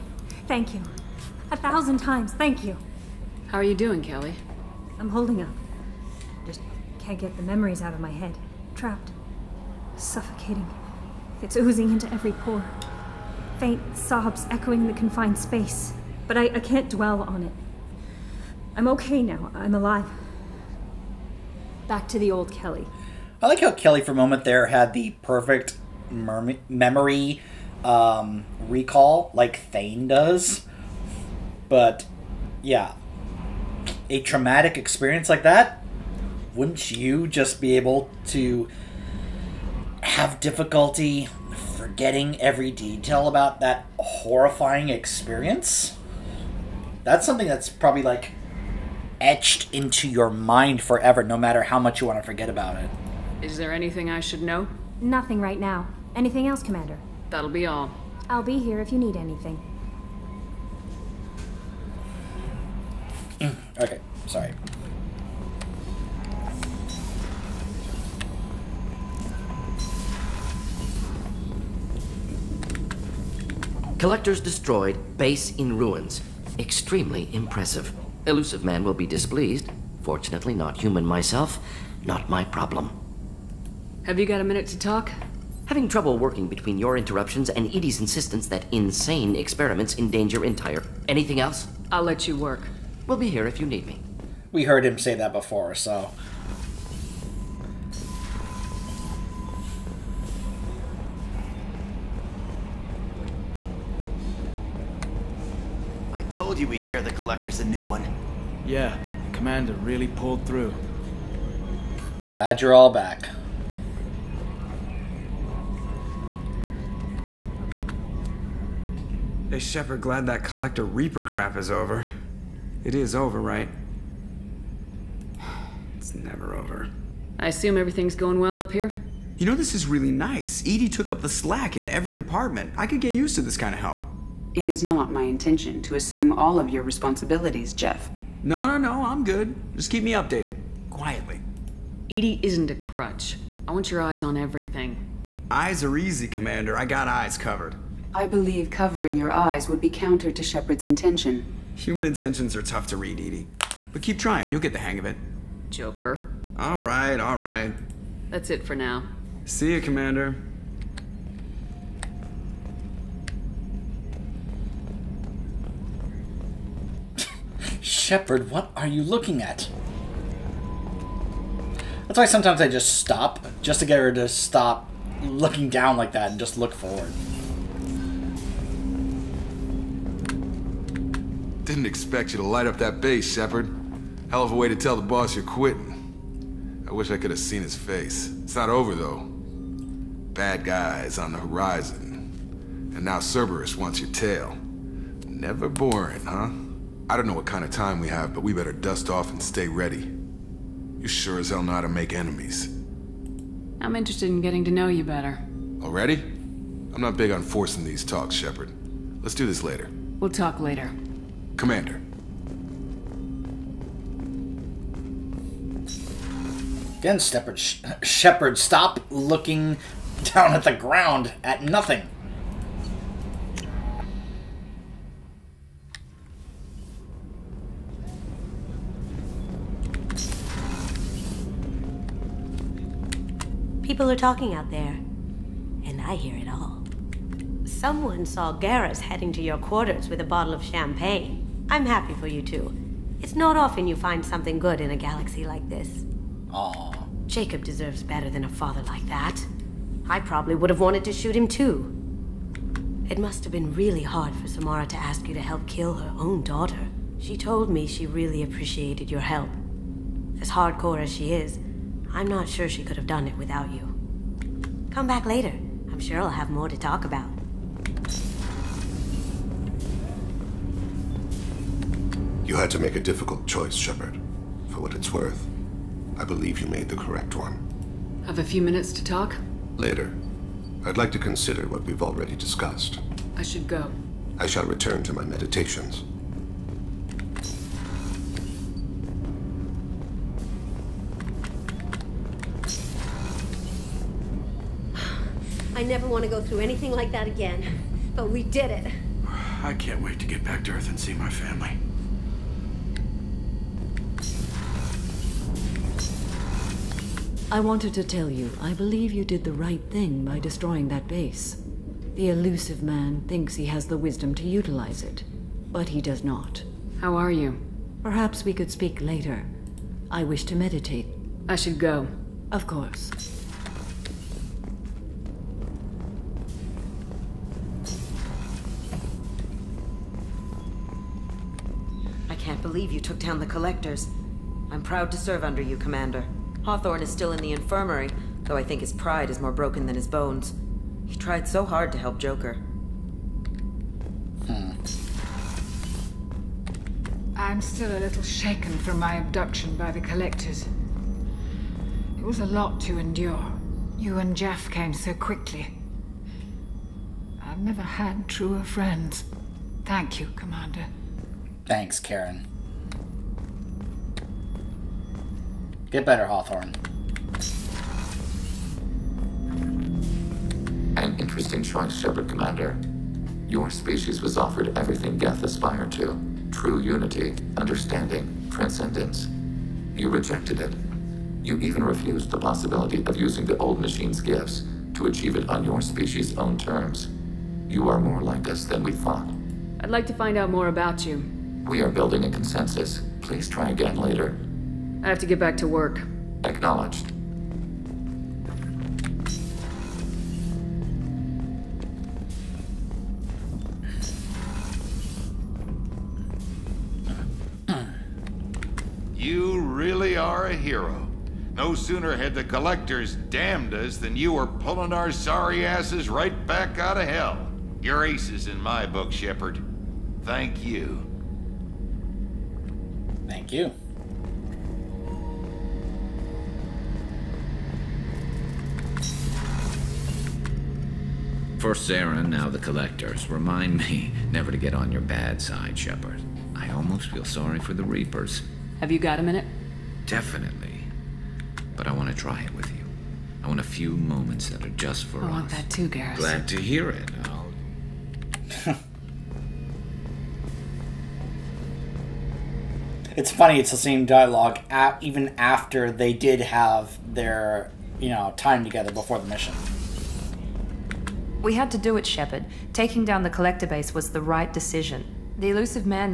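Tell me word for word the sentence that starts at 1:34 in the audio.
We heard him say that before, so.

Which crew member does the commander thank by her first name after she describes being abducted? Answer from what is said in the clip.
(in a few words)
Karen.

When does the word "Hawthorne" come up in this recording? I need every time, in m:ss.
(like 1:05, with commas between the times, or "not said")
5:36, 6:06.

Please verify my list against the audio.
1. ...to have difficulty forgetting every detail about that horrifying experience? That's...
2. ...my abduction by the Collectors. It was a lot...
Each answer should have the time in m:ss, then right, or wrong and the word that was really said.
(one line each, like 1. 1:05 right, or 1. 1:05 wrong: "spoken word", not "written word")
1. 0:38 right
2. 5:48 right.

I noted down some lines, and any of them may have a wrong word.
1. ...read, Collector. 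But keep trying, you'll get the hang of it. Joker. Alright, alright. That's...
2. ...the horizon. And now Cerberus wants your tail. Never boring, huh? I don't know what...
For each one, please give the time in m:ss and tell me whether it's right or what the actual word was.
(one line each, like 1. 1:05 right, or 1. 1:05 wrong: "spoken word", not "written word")
1. 2:32 wrong: "EDI", not "Collector"
2. 3:11 right.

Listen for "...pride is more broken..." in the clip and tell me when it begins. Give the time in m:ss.
5:38.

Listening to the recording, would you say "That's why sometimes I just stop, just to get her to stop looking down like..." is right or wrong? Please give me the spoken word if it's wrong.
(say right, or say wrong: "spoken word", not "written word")
right.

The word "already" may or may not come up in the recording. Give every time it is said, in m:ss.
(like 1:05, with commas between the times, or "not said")
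3:25, 4:41.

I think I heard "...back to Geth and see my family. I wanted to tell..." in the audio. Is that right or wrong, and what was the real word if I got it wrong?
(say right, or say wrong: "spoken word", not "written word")
wrong: "Earth", not "Geth".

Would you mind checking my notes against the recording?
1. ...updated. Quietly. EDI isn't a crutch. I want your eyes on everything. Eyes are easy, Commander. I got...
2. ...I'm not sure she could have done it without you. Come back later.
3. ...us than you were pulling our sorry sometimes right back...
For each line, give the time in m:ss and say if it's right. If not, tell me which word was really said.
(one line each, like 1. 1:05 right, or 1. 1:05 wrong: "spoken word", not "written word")
1. 2:20 right
2. 4:22 right
3. 6:53 wrong: "asses", not "sometimes".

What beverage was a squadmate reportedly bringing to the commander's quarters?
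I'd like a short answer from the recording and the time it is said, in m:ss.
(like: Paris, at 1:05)
Champagne, at 4:00.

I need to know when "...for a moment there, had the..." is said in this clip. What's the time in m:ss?
0:23.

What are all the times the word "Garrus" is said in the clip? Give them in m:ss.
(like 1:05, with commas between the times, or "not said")
3:58, 7:25.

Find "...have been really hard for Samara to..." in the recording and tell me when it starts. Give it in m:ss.
4:13.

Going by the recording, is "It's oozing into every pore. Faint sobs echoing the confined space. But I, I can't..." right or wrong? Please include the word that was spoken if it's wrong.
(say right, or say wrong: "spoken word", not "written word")
right.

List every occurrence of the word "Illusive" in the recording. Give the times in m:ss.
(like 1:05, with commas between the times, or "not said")
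1:18, 5:12, 7:45.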